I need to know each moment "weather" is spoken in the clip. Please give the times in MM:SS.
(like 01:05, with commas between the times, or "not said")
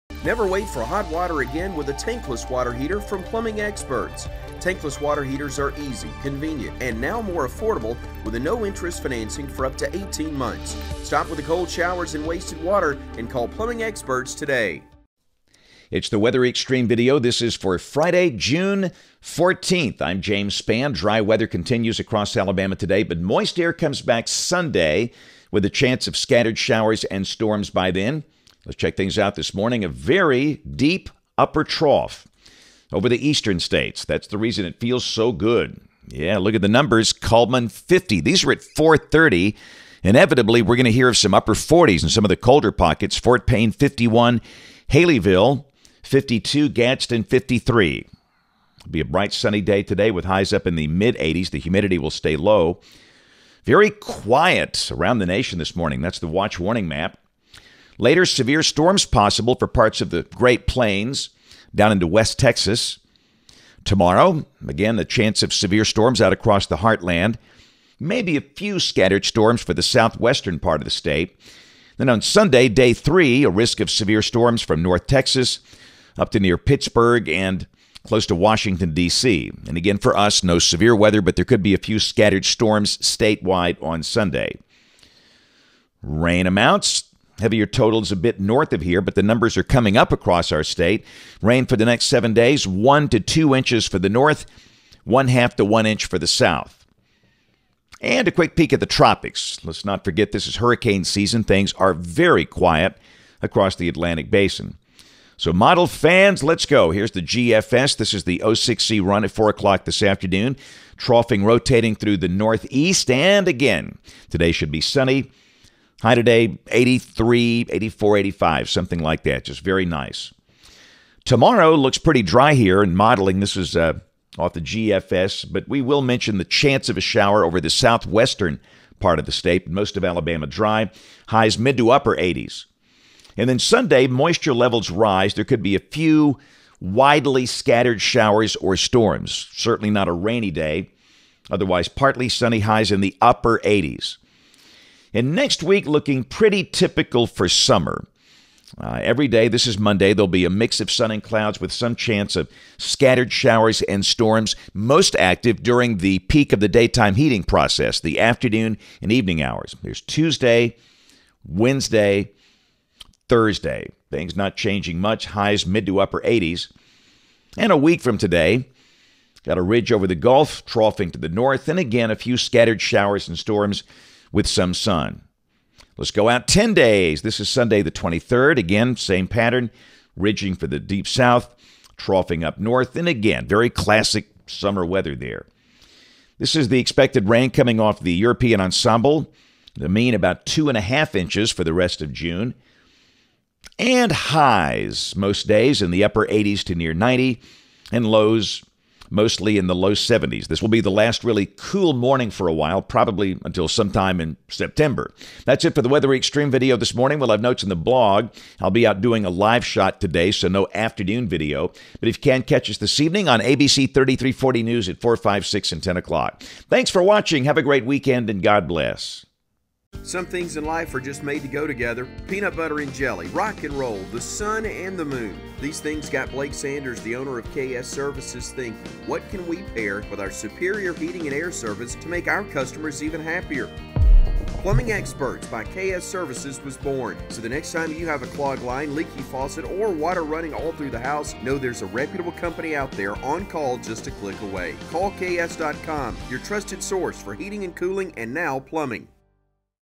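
00:16, 00:21, 01:20, 03:04, 03:25.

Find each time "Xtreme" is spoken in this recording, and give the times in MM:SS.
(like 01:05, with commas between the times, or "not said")
00:16, 03:26.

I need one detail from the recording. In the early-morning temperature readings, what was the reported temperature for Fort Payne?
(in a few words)
51.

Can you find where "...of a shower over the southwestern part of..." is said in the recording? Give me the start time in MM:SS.
02:06.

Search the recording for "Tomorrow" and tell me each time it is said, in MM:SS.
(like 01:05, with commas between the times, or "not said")
01:03, 02:01.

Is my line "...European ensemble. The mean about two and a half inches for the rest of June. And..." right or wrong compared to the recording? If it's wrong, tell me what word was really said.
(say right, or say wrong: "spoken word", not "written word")
right.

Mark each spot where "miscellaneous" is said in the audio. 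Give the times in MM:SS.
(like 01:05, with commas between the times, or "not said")
not said.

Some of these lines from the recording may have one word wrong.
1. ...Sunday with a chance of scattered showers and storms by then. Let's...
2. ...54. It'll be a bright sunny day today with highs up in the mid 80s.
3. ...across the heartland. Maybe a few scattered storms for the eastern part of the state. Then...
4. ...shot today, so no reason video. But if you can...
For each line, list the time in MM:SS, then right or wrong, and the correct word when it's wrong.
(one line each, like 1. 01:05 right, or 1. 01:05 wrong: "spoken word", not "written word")
1. 00:24 right
2. 00:47 wrong: "53", not "54"
3. 01:06 wrong: "southwestern", not "eastern"
4. 03:29 wrong: "afternoon", not "reason".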